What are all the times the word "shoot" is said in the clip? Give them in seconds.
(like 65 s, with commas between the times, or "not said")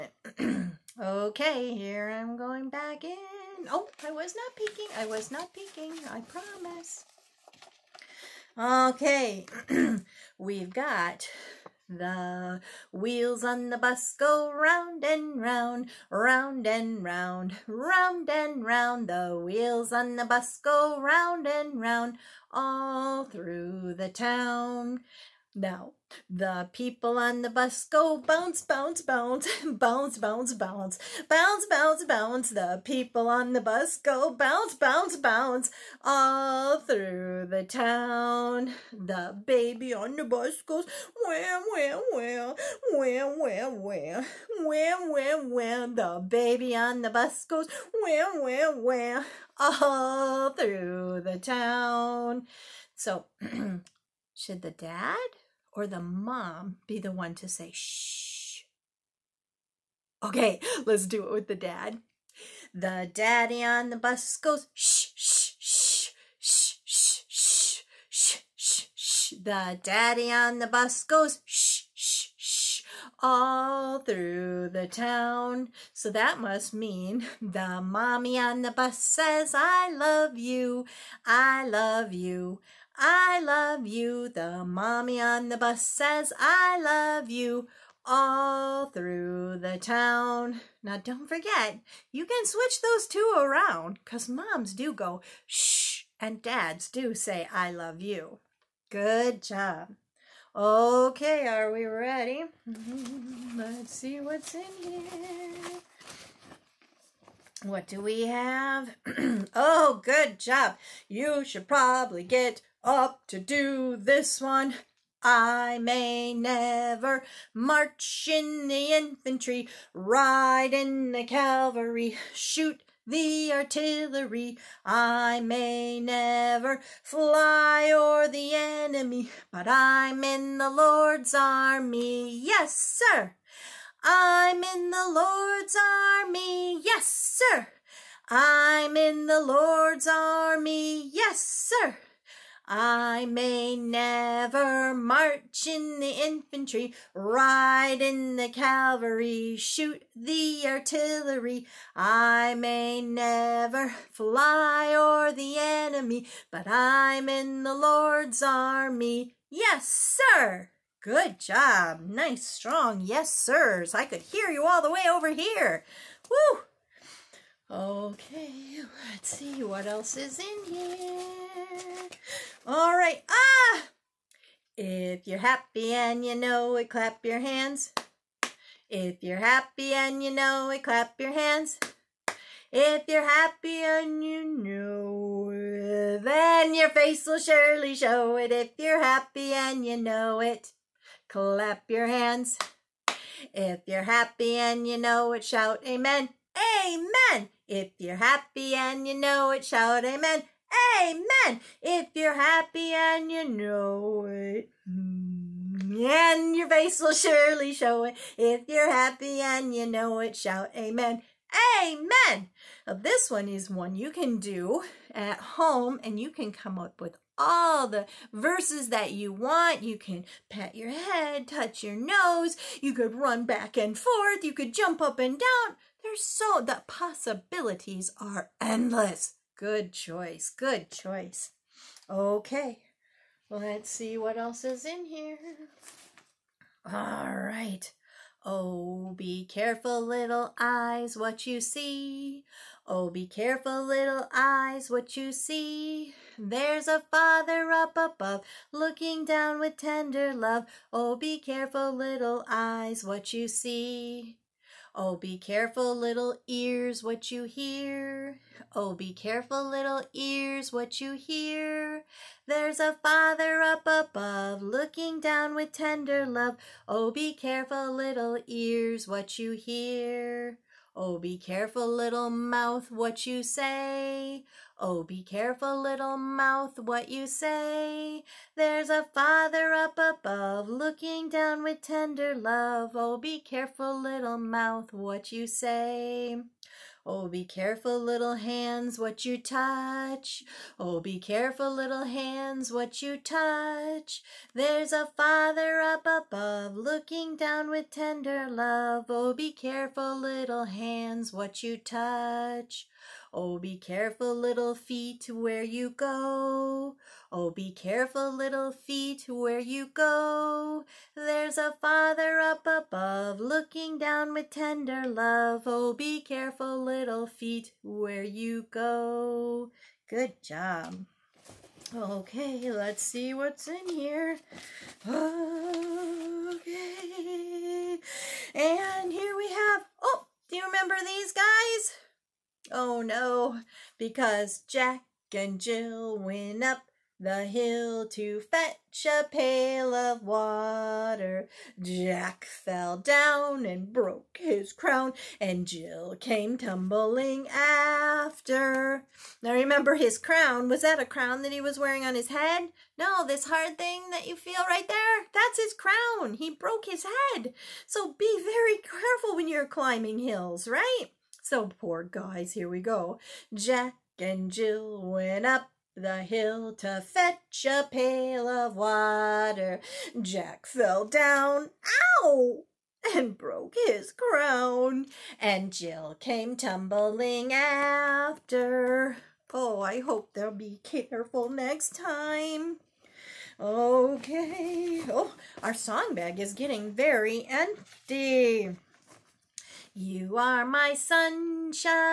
122 s, 149 s.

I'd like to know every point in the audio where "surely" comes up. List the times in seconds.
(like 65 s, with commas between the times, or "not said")
187 s, 207 s.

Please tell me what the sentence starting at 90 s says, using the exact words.
Now, don't forget, you can switch those two around because moms do go shh and dads do say, I love you.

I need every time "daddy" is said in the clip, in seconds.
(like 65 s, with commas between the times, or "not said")
63 s, 69 s.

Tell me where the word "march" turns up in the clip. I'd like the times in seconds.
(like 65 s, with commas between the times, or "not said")
117 s, 144 s.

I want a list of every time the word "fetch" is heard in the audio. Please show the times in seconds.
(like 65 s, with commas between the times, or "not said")
338 s, 367 s.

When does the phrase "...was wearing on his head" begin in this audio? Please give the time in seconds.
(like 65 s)
351 s.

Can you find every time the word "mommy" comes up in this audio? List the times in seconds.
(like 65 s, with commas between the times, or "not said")
77 s, 84 s.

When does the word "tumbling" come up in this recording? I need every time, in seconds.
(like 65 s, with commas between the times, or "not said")
346 s, 376 s.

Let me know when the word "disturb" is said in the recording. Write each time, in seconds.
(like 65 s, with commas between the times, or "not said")
not said.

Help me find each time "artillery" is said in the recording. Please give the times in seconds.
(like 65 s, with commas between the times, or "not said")
123 s, 150 s.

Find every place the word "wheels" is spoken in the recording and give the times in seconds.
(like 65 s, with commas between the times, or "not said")
12 s, 19 s.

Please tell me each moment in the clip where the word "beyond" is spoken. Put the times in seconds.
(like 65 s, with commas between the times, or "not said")
not said.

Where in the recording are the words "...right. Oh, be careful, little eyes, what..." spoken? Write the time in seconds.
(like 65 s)
237 s.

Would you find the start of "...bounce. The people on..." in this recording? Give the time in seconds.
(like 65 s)
32 s.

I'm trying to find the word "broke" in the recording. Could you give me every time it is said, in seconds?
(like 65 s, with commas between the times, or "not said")
343 s, 356 s, 373 s.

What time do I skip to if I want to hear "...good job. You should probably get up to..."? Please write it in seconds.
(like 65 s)
110 s.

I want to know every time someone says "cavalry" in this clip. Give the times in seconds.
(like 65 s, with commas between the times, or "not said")
121 s, 148 s.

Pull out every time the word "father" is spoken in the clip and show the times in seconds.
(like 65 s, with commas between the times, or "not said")
247 s, 263 s, 279 s, 295 s, 311 s.